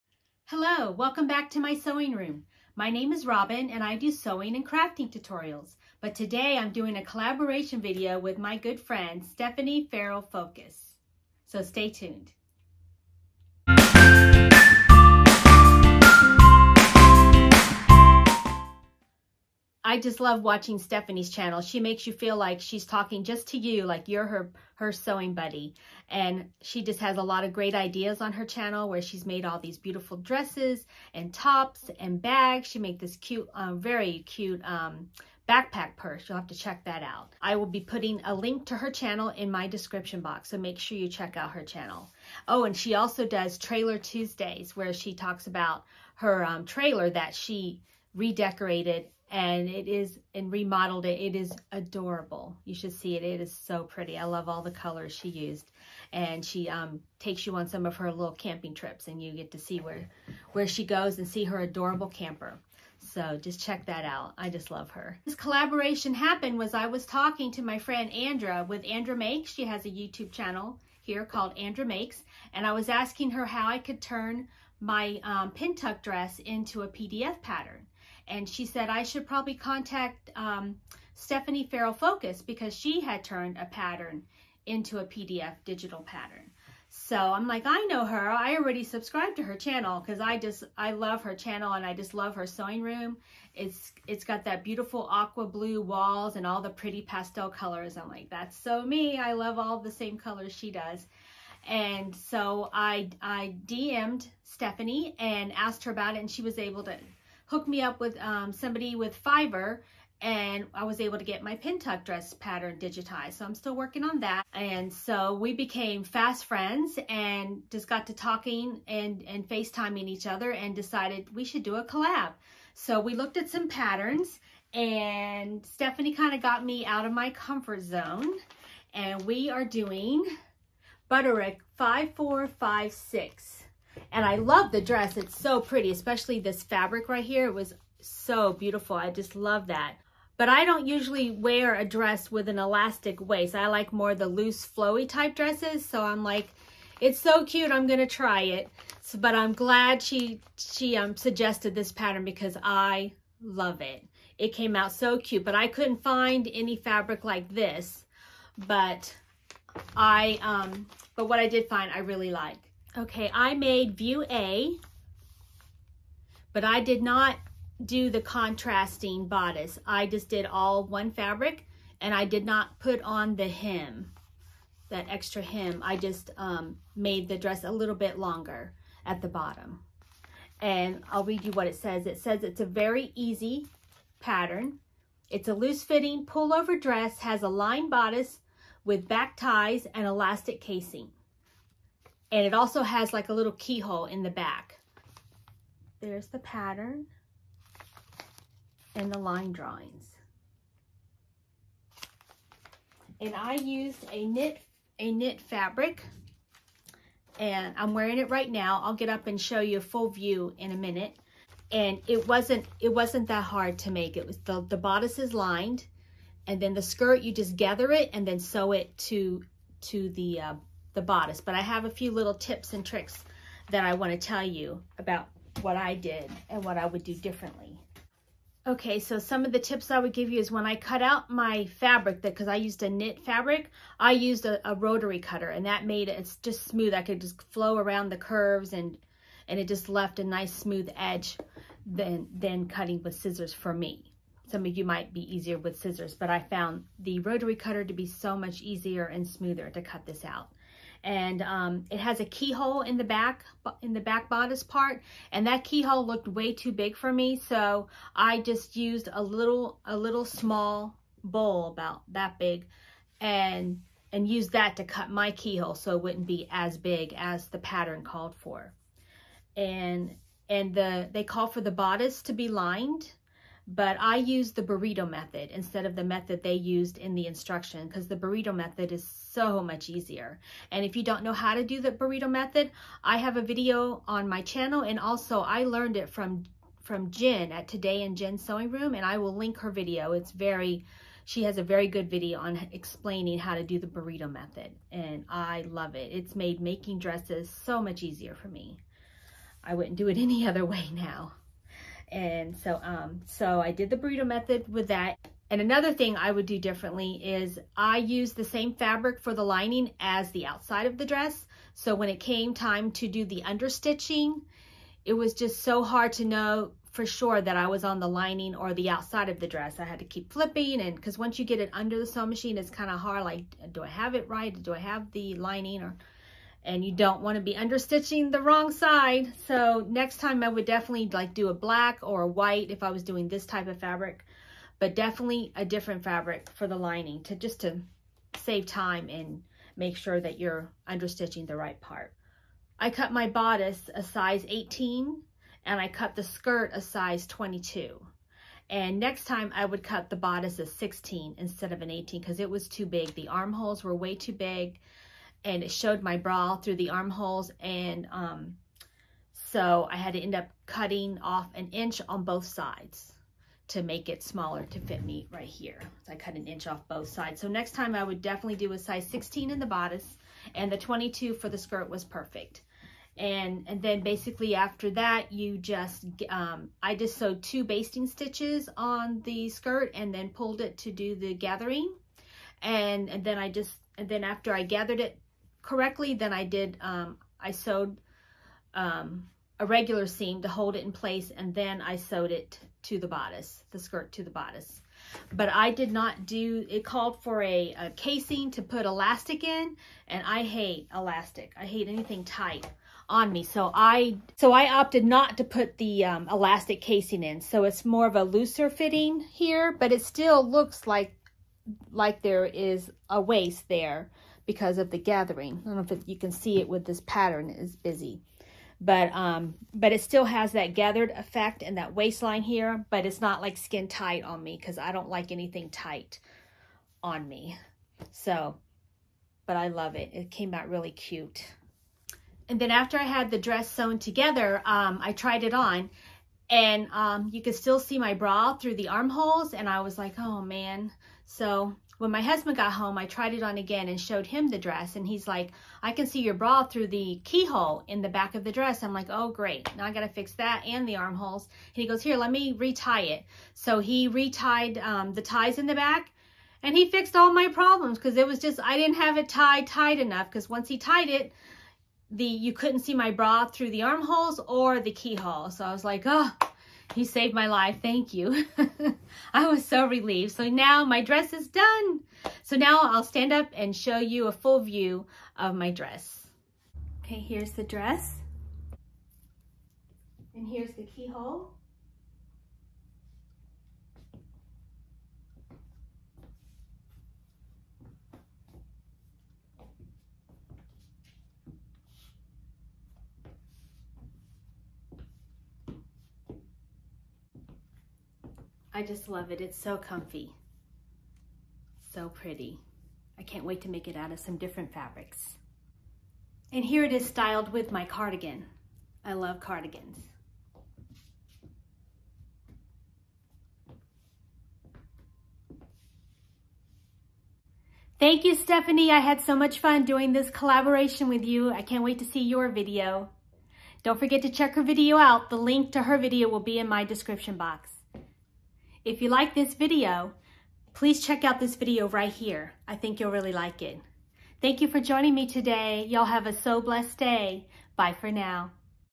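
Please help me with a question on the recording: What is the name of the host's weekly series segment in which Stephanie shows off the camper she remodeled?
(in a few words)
Trailer Tuesdays.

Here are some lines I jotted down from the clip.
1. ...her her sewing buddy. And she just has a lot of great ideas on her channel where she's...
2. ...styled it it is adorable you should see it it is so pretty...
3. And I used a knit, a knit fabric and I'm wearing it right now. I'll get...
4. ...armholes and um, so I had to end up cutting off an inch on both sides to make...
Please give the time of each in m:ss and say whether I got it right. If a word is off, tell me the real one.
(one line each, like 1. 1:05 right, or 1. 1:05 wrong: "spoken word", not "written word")
1. 0:24 right
2. 0:50 wrong: "remodeled", not "styled"
3. 3:23 right
4. 5:56 right.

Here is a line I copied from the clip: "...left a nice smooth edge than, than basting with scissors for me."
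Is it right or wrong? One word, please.
wrong.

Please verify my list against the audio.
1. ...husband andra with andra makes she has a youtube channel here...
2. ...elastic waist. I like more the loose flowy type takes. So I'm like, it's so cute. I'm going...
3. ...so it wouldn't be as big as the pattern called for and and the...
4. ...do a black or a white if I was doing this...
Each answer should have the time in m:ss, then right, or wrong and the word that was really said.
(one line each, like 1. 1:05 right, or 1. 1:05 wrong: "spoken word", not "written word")
1. 1:07 wrong: "friend", not "husband"
2. 2:22 wrong: "dresses", not "takes"
3. 4:25 right
4. 5:31 right.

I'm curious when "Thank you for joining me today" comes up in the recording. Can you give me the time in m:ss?
8:54.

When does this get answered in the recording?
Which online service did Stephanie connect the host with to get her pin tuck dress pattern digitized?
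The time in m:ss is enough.
1:49.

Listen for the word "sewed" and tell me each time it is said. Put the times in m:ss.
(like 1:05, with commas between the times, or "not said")
6:17, 6:27, 6:31.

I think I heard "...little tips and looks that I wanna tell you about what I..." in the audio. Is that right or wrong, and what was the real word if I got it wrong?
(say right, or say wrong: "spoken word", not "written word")
wrong: "tricks", not "looks".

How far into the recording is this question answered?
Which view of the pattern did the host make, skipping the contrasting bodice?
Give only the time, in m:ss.
2:43.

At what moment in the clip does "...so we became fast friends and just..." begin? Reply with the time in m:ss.
1:54.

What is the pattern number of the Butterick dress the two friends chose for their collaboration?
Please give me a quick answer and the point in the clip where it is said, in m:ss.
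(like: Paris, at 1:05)
5456, at 2:11.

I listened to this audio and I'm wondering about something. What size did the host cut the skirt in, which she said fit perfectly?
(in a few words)
22.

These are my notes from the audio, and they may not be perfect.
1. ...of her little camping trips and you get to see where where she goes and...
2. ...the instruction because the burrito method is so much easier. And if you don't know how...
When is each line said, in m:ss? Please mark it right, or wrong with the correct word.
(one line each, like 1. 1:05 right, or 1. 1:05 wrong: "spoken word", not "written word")
1. 0:57 right
2. 4:37 right.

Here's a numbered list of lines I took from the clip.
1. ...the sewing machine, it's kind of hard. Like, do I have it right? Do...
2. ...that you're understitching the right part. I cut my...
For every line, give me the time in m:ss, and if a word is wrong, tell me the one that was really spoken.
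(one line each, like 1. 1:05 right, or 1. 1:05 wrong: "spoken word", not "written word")
1. 5:21 right
2. 5:40 right.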